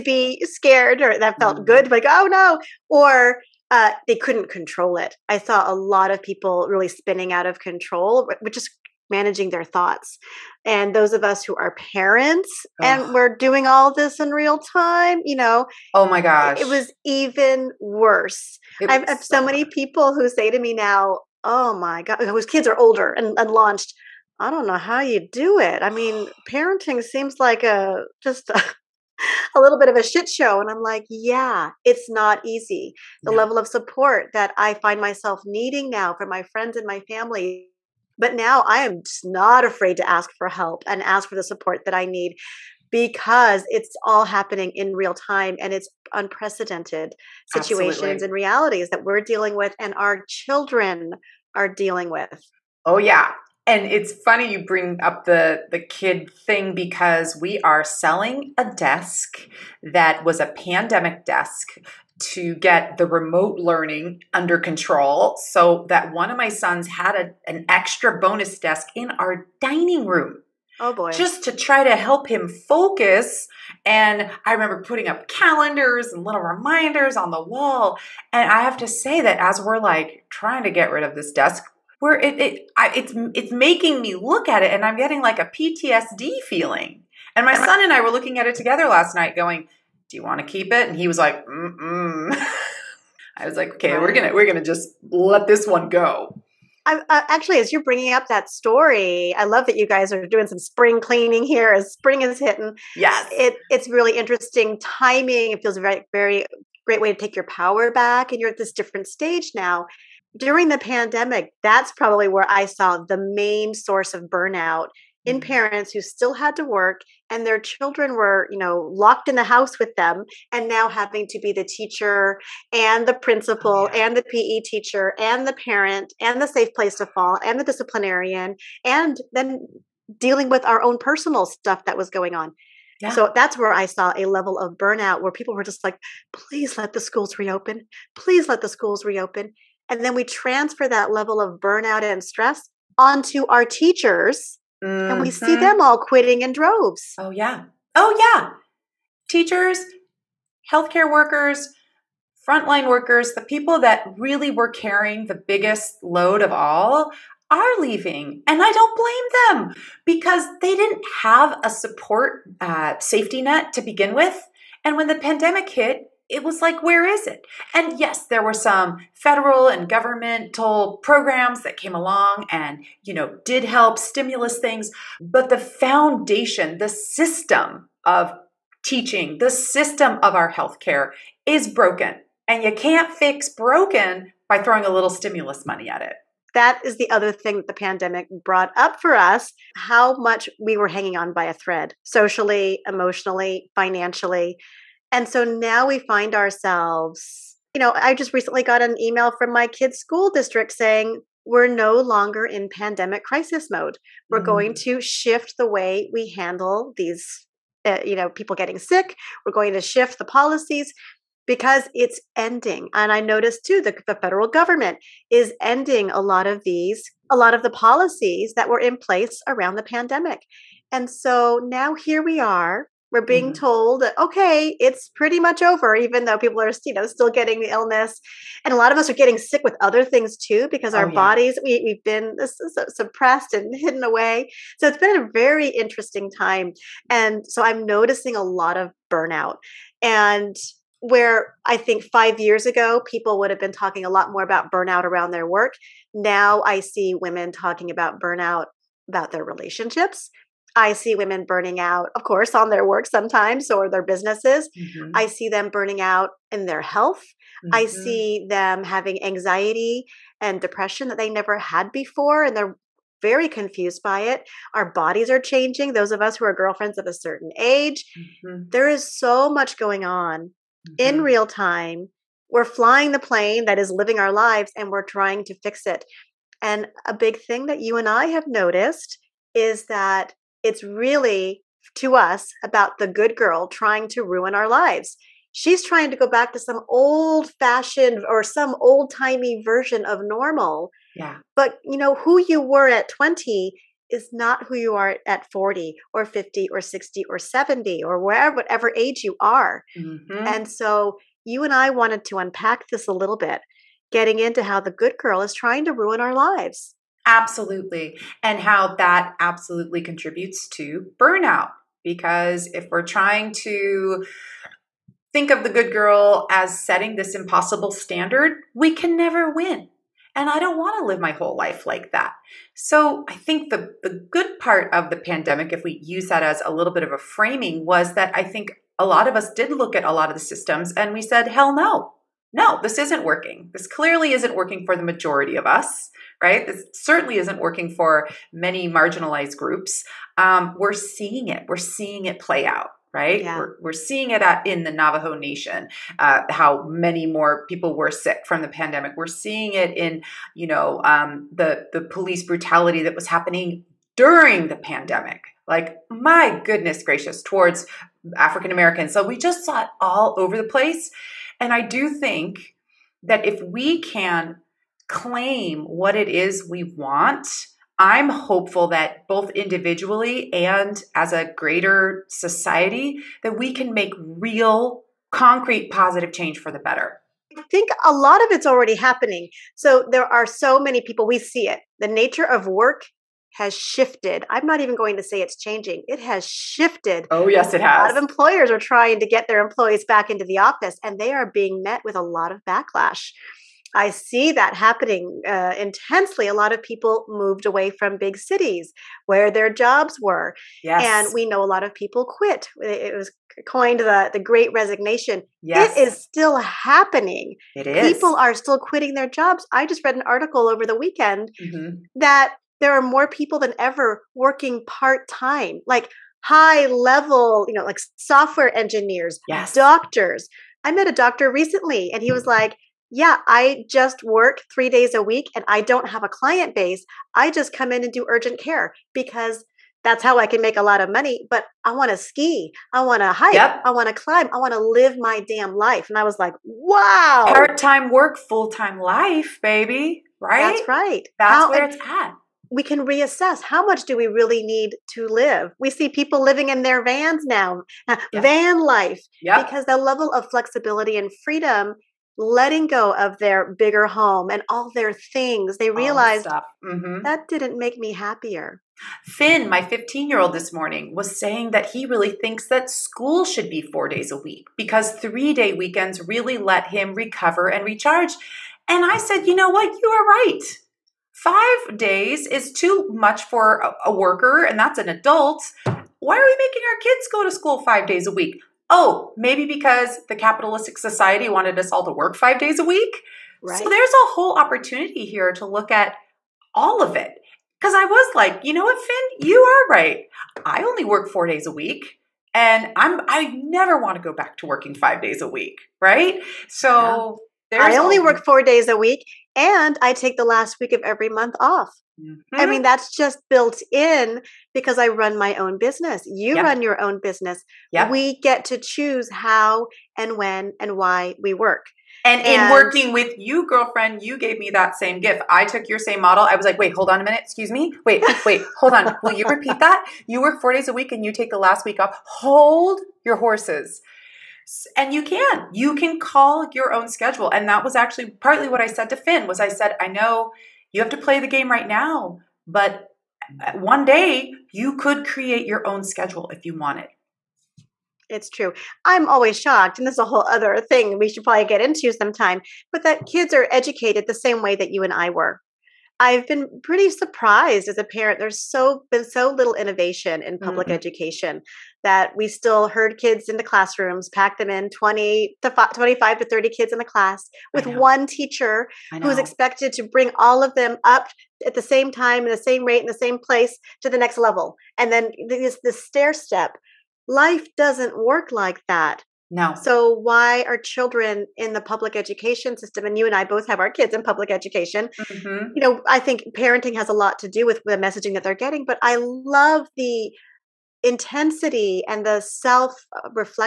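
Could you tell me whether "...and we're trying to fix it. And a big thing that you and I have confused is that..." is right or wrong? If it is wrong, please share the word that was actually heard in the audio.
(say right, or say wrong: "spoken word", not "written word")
wrong: "noticed", not "confused".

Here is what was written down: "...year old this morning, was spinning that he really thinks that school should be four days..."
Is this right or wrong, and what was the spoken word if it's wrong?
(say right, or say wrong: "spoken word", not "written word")
wrong: "saying", not "spinning".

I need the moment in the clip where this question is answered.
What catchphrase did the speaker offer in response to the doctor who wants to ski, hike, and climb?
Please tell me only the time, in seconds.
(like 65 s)
437 s.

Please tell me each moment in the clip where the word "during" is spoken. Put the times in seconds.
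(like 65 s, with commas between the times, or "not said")
110 s, 354 s.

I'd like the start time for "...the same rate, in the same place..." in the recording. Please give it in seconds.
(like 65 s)
562 s.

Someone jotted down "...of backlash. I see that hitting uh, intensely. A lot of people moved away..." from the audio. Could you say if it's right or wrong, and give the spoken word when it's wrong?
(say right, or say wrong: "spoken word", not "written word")
wrong: "happening", not "hitting".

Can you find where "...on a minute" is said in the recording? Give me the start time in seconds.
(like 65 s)
517 s.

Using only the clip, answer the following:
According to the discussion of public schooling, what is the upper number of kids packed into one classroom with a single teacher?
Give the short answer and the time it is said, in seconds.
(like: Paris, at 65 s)
30, at 556 s.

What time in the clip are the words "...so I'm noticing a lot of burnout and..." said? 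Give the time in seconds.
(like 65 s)
237 s.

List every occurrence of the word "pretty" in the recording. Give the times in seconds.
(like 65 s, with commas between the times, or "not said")
225 s, 546 s.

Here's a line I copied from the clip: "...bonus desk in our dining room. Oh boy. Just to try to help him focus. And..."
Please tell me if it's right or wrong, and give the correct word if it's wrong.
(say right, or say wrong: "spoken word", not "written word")
right.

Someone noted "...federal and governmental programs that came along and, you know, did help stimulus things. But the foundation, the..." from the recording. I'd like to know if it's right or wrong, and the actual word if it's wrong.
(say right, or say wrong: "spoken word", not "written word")
right.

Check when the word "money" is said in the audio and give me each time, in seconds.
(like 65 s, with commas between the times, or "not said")
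185 s, 431 s.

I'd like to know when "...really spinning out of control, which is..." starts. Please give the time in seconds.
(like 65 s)
6 s.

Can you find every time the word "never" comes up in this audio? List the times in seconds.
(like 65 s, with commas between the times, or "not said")
261 s, 319 s, 493 s.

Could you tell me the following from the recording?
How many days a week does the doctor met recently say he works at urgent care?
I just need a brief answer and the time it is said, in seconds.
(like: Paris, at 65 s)
3, at 424 s.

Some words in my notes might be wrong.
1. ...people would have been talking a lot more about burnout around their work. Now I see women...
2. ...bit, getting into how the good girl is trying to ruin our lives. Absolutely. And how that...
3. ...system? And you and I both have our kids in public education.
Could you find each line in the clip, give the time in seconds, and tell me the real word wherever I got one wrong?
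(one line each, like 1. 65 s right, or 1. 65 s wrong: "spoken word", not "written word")
1. 243 s right
2. 303 s right
3. 572 s right.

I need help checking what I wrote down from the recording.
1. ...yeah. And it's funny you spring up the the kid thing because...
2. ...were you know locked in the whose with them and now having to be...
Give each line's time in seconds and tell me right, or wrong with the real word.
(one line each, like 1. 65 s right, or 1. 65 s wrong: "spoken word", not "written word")
1. 52 s wrong: "bring", not "spring"
2. 118 s wrong: "house", not "whose".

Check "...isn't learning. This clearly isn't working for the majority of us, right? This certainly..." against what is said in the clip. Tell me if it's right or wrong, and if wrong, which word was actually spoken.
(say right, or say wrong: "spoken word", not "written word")
wrong: "working", not "learning".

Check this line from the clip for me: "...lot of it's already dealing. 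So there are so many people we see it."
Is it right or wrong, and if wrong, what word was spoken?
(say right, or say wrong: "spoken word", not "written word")
wrong: "happening", not "dealing".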